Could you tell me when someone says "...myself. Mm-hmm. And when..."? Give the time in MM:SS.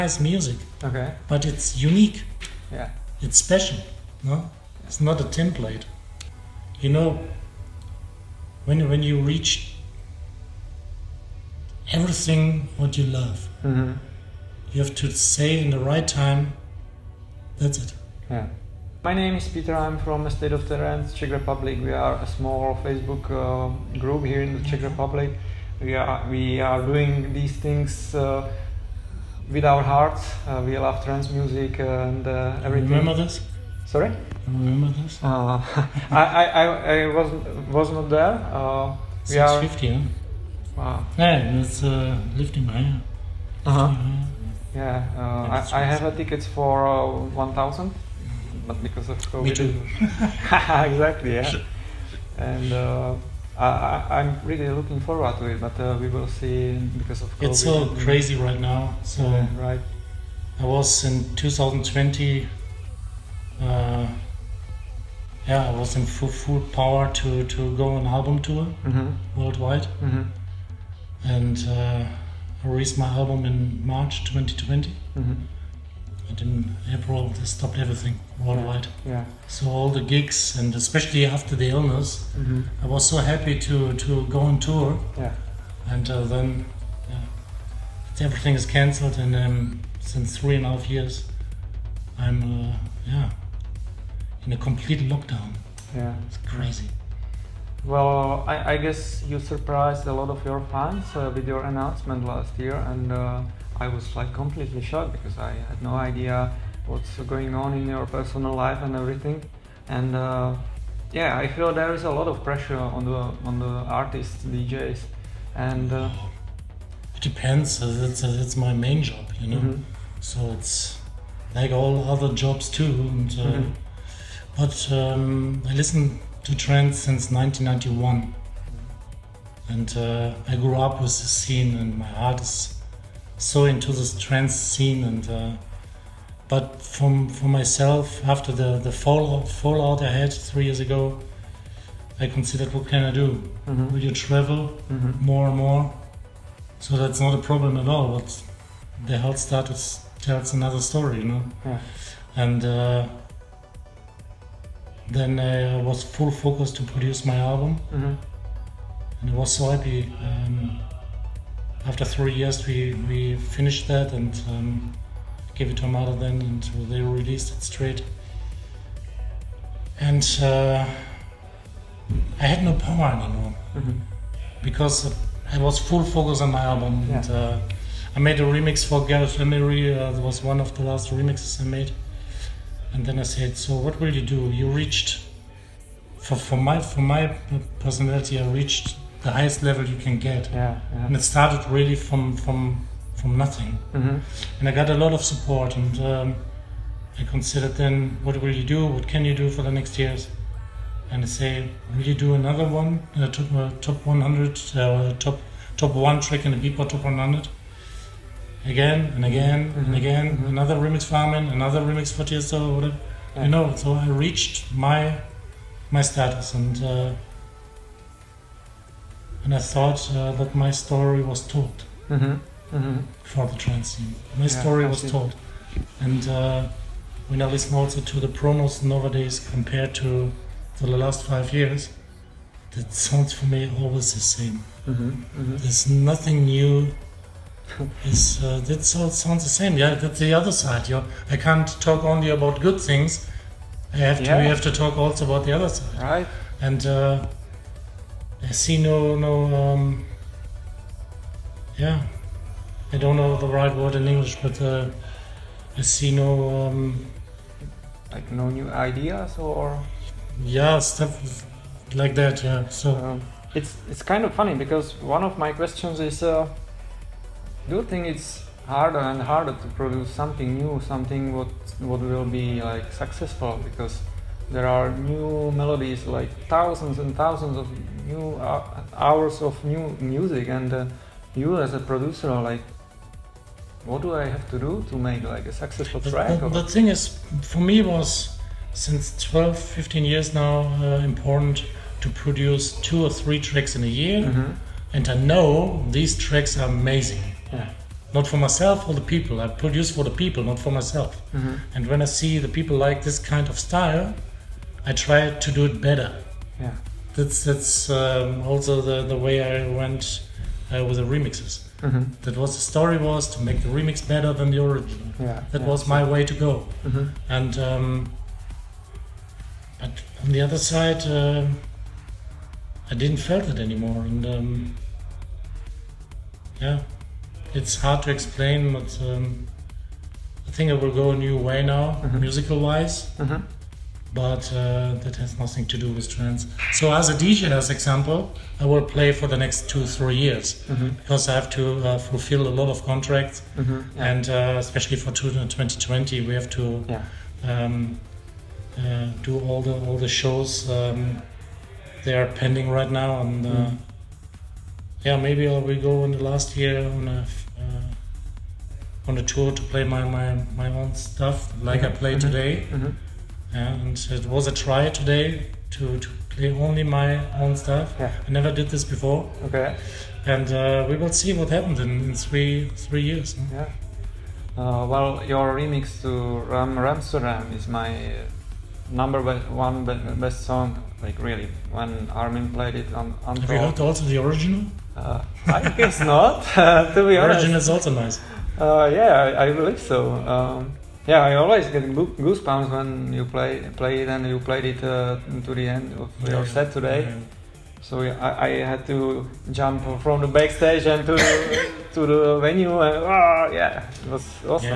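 05:00.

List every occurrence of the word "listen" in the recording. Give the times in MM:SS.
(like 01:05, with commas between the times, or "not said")
02:05, 03:47.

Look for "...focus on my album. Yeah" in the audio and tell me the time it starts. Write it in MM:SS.
02:56.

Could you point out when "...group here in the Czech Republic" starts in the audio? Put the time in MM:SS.
00:23.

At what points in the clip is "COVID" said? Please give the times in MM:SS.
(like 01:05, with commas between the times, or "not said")
00:49, 00:57.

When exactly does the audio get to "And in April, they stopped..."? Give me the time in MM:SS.
01:16.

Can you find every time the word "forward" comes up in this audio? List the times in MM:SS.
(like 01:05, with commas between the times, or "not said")
00:54.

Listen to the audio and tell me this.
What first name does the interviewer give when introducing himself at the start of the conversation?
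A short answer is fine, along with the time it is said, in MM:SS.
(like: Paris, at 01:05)
Peter, at 00:19.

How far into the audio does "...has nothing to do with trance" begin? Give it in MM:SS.
05:35.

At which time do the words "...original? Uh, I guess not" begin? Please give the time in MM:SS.
06:24.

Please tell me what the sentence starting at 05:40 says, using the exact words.
because I have to uh, fulfill a lot of contracts, mm-hmm.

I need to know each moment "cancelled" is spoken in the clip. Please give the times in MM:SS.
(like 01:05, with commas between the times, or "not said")
01:28.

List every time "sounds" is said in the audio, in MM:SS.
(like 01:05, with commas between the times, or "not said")
03:52, 03:59.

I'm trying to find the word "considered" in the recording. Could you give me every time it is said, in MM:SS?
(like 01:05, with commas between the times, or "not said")
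02:22, 03:17.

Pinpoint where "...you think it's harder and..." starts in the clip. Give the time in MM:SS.
04:27.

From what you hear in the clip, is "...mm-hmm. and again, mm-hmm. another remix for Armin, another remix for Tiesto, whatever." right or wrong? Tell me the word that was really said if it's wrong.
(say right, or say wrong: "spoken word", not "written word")
right.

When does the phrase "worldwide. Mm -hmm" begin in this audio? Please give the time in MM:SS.
01:09.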